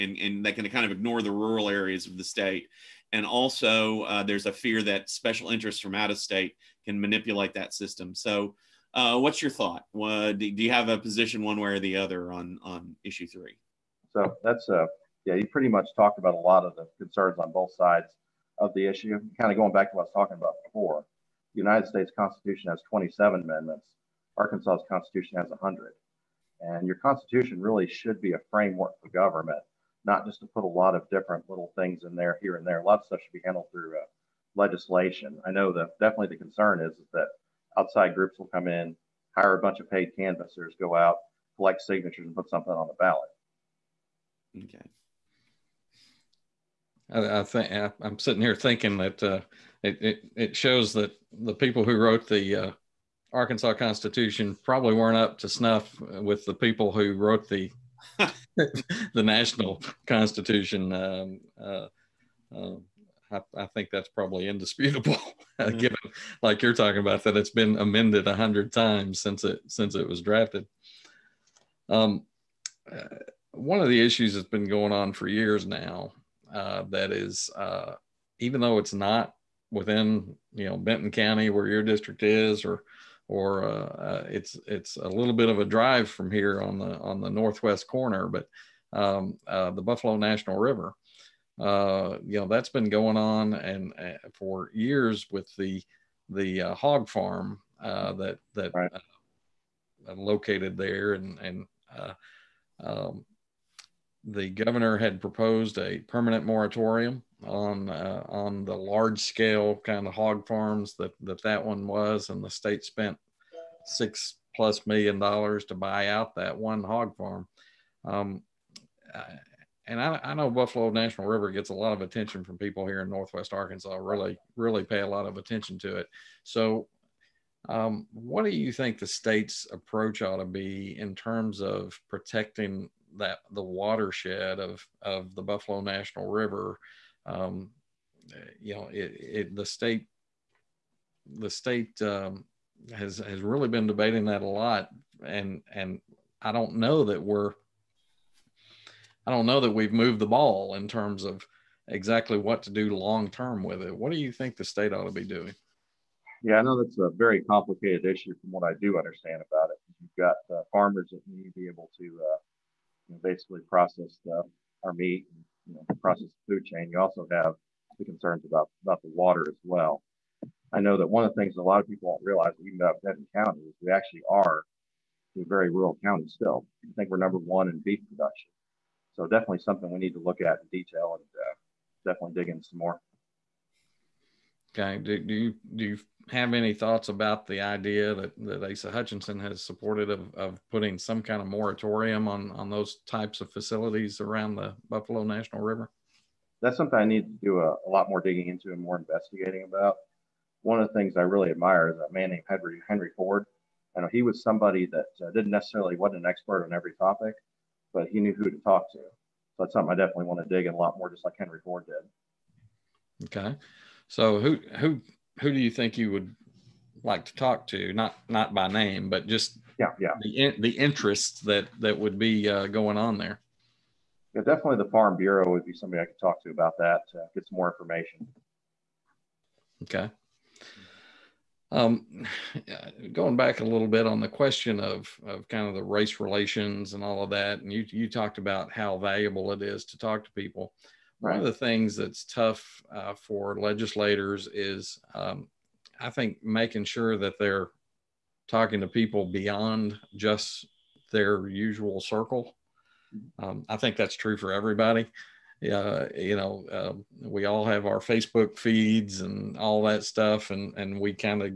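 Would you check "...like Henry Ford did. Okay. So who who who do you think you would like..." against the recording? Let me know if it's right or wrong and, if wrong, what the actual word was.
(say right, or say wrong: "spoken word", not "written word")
right.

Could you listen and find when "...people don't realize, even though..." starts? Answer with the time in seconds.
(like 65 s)
171 s.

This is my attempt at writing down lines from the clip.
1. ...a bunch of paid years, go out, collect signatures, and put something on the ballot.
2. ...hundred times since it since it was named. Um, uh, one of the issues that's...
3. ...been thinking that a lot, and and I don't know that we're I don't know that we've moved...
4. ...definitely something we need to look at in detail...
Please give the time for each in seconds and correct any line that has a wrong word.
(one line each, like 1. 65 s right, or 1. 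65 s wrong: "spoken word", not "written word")
1. 39 s wrong: "canvassers", not "years"
2. 68 s wrong: "drafted", not "named"
3. 143 s wrong: "debating", not "thinking"
4. 179 s right.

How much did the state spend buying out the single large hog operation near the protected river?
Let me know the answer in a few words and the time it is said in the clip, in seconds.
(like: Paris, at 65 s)
six plus million dollars, at 113 s.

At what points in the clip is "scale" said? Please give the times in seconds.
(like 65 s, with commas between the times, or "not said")
109 s.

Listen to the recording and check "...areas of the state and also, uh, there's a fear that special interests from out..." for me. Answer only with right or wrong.
right.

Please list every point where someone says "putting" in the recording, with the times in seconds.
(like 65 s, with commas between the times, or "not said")
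190 s.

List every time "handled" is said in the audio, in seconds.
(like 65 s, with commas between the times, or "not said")
33 s.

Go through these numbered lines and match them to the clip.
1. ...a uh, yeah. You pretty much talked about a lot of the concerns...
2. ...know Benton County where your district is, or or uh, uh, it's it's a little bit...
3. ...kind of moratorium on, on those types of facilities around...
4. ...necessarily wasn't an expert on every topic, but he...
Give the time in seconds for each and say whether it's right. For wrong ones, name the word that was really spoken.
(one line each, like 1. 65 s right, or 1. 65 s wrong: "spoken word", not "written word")
1. 14 s right
2. 80 s right
3. 191 s right
4. 205 s right.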